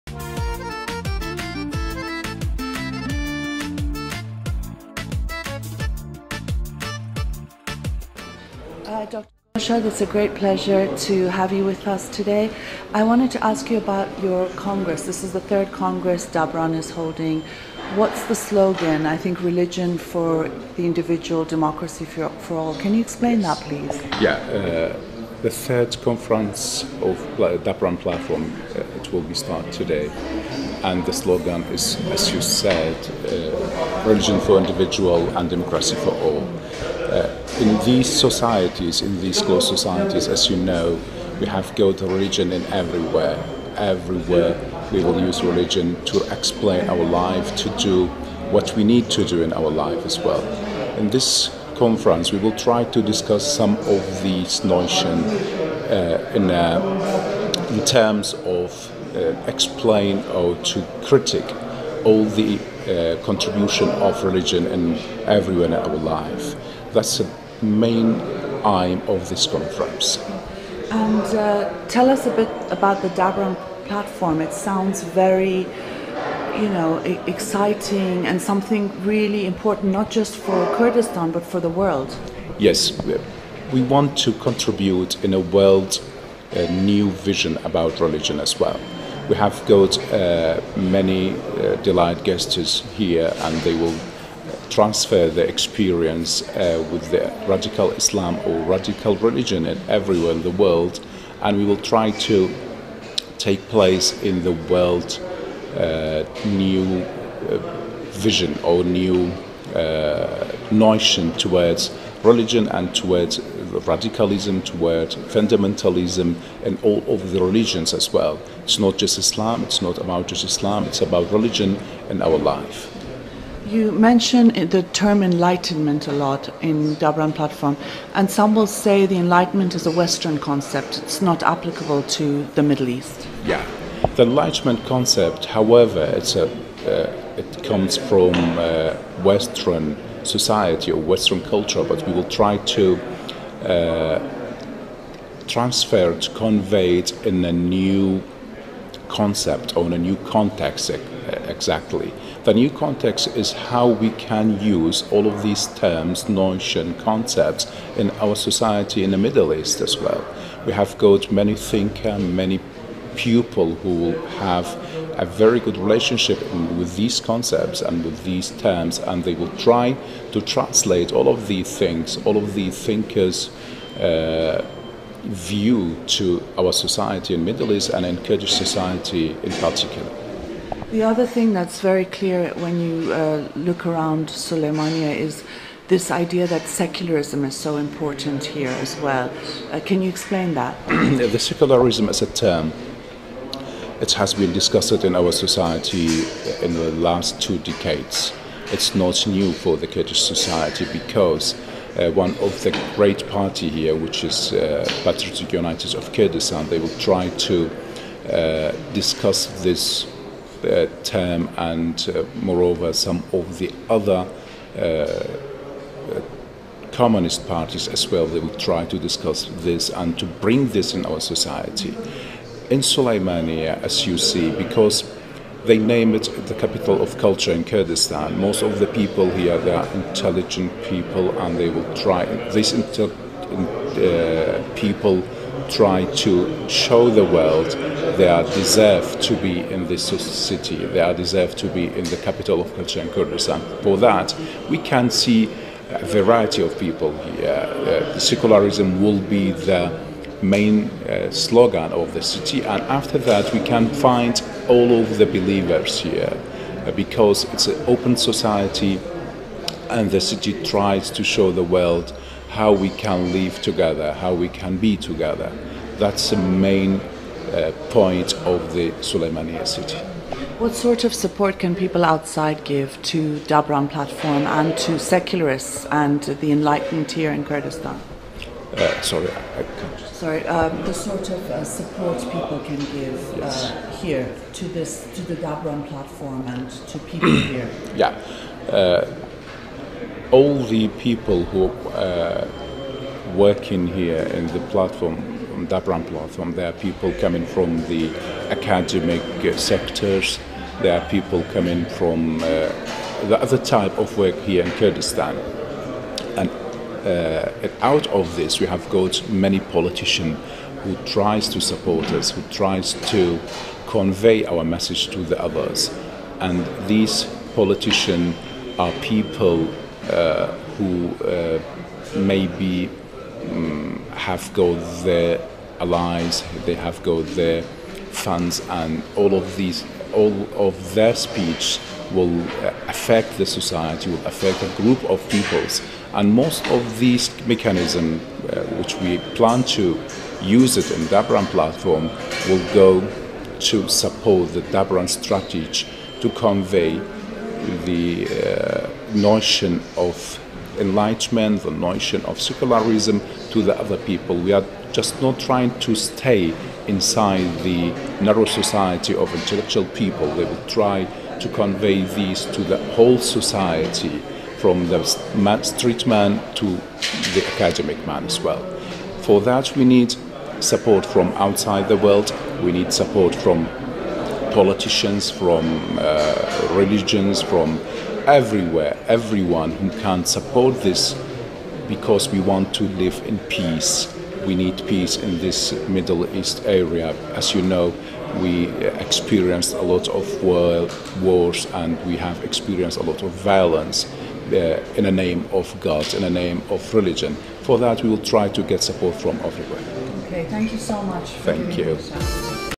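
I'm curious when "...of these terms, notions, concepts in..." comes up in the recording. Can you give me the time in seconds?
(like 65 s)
155 s.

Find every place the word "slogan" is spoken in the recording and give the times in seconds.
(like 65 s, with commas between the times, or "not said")
18 s, 31 s, 251 s.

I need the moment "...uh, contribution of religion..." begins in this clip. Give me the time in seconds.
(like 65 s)
62 s.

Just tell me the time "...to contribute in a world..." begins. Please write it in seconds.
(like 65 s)
84 s.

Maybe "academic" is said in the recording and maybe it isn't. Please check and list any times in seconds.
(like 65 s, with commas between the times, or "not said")
298 s, 367 s.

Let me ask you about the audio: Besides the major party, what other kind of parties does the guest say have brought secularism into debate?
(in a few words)
Communist parties.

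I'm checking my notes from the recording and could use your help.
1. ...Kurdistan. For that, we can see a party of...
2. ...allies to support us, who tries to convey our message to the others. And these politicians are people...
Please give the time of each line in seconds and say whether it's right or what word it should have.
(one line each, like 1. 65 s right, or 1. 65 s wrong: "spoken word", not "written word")
1. 243 s wrong: "variety", not "party"
2. 311 s wrong: "tries", not "allies".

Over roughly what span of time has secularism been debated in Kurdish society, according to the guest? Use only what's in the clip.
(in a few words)
Two decades.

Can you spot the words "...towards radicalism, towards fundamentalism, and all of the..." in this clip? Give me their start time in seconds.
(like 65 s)
112 s.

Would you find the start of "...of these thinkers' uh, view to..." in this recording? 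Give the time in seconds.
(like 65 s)
172 s.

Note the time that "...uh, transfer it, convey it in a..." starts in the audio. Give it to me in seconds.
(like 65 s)
143 s.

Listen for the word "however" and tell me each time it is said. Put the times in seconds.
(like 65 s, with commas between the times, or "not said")
135 s.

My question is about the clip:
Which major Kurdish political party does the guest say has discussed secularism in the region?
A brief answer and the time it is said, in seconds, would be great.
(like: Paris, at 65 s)
Patriotic United of Kurdistan, at 205 s.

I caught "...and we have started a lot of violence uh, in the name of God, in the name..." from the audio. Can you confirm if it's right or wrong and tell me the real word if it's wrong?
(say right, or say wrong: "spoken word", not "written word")
wrong: "experienced", not "started".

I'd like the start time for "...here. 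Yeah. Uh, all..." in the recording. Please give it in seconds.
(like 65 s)
287 s.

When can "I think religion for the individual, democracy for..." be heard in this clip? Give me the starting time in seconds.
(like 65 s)
19 s.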